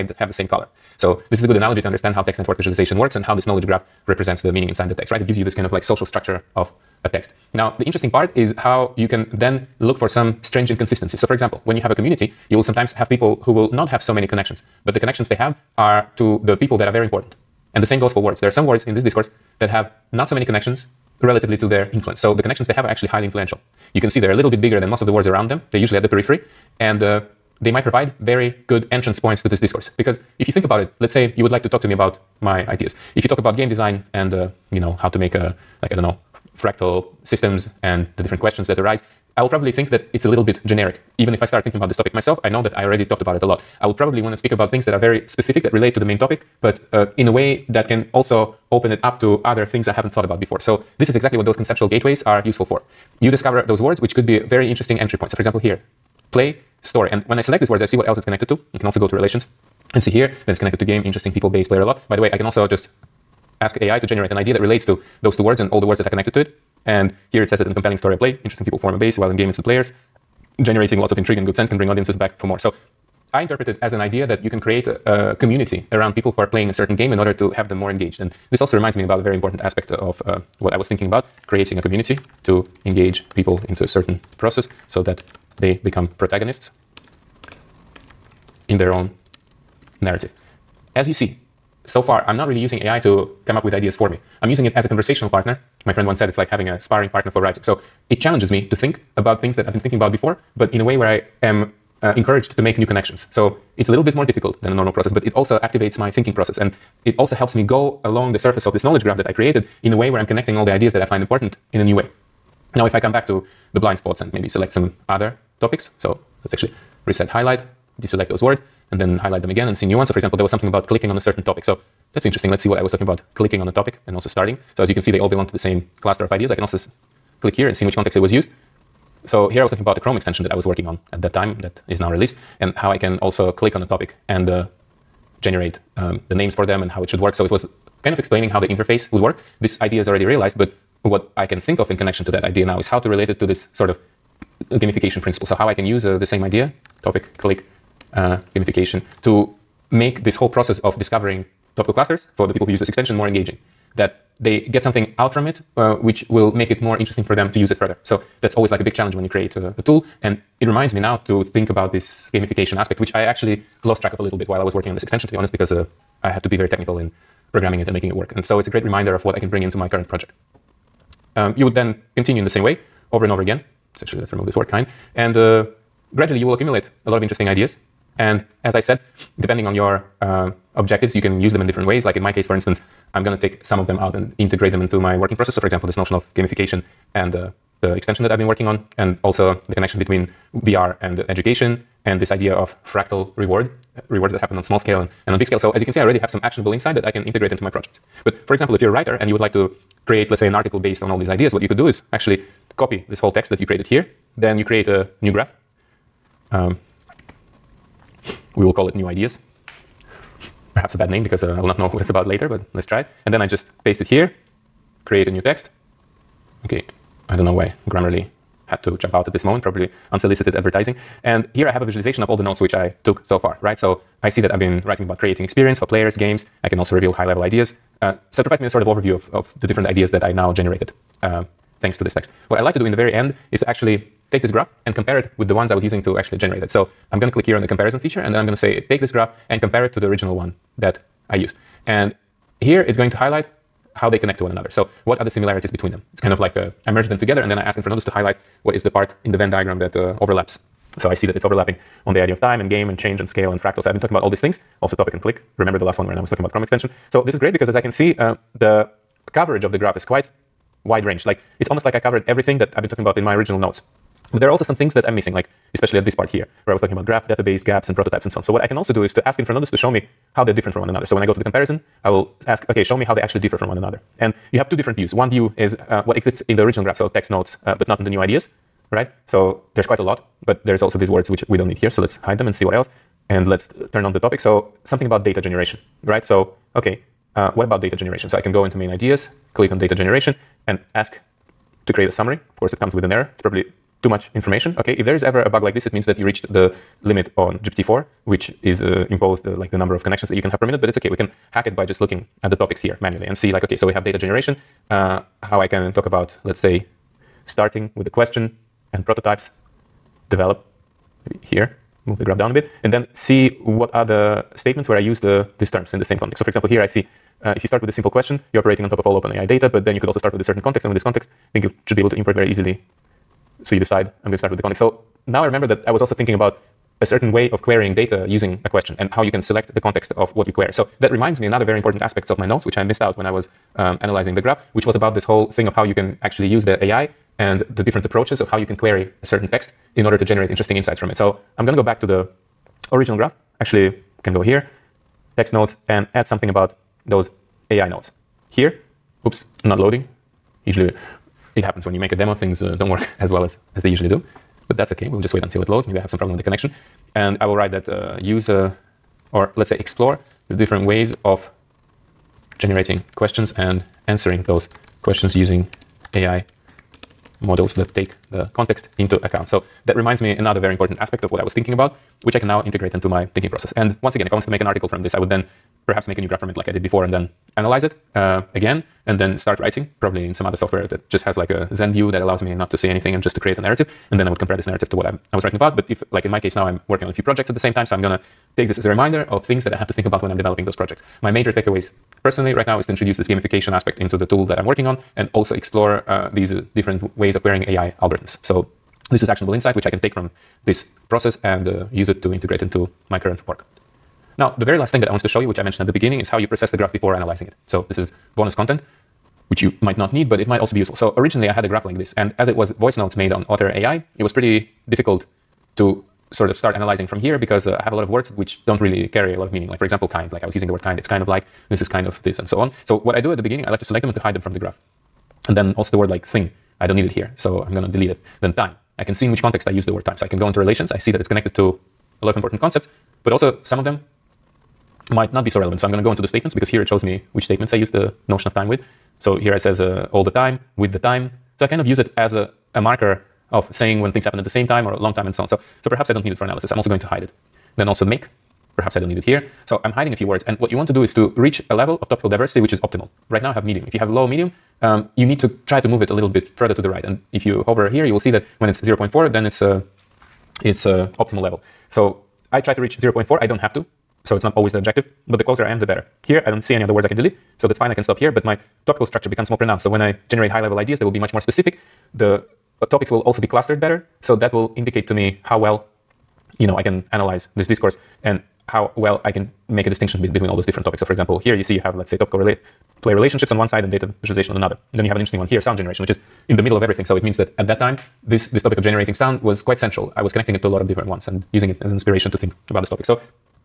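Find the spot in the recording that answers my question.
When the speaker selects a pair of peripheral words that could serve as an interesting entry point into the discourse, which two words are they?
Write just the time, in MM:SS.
00:56.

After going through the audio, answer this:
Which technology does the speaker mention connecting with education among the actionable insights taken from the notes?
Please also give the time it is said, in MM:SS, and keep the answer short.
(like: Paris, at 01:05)
VR, at 03:10.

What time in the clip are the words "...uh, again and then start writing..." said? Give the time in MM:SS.
06:18.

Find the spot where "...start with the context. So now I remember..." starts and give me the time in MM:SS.
05:24.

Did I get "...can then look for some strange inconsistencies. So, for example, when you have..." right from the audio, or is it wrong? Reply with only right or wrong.
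right.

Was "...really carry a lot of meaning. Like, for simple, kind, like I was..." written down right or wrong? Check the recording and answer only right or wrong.
wrong.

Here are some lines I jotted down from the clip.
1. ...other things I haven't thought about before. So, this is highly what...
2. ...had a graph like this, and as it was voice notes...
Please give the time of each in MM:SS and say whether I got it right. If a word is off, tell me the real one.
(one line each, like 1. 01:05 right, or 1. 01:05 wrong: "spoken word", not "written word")
1. 00:49 wrong: "exactly", not "highly"
2. 06:51 right.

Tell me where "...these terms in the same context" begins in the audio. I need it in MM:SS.
05:15.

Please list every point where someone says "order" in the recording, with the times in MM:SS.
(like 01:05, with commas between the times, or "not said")
01:17, 05:40.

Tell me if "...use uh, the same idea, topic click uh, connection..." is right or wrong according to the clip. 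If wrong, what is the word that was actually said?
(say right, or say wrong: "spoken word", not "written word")
wrong: "gamification", not "connection".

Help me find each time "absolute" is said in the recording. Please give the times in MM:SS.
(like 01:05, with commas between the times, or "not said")
not said.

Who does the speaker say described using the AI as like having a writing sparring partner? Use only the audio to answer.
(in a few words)
My friend.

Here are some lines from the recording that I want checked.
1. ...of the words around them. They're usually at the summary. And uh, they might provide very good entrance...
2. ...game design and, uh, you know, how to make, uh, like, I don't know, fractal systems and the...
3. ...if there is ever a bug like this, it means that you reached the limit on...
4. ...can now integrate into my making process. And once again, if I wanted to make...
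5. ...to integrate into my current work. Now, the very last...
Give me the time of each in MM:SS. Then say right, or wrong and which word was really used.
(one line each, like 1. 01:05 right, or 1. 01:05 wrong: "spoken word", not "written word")
1. 00:25 wrong: "periphery", not "summary"
2. 00:33 right
3. 04:54 right
4. 06:12 wrong: "thinking", not "making"
5. 06:42 right.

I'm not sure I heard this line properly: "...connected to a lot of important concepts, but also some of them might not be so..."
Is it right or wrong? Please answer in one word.
right.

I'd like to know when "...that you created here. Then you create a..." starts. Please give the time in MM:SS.
03:23.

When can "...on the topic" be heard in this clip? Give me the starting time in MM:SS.
04:44.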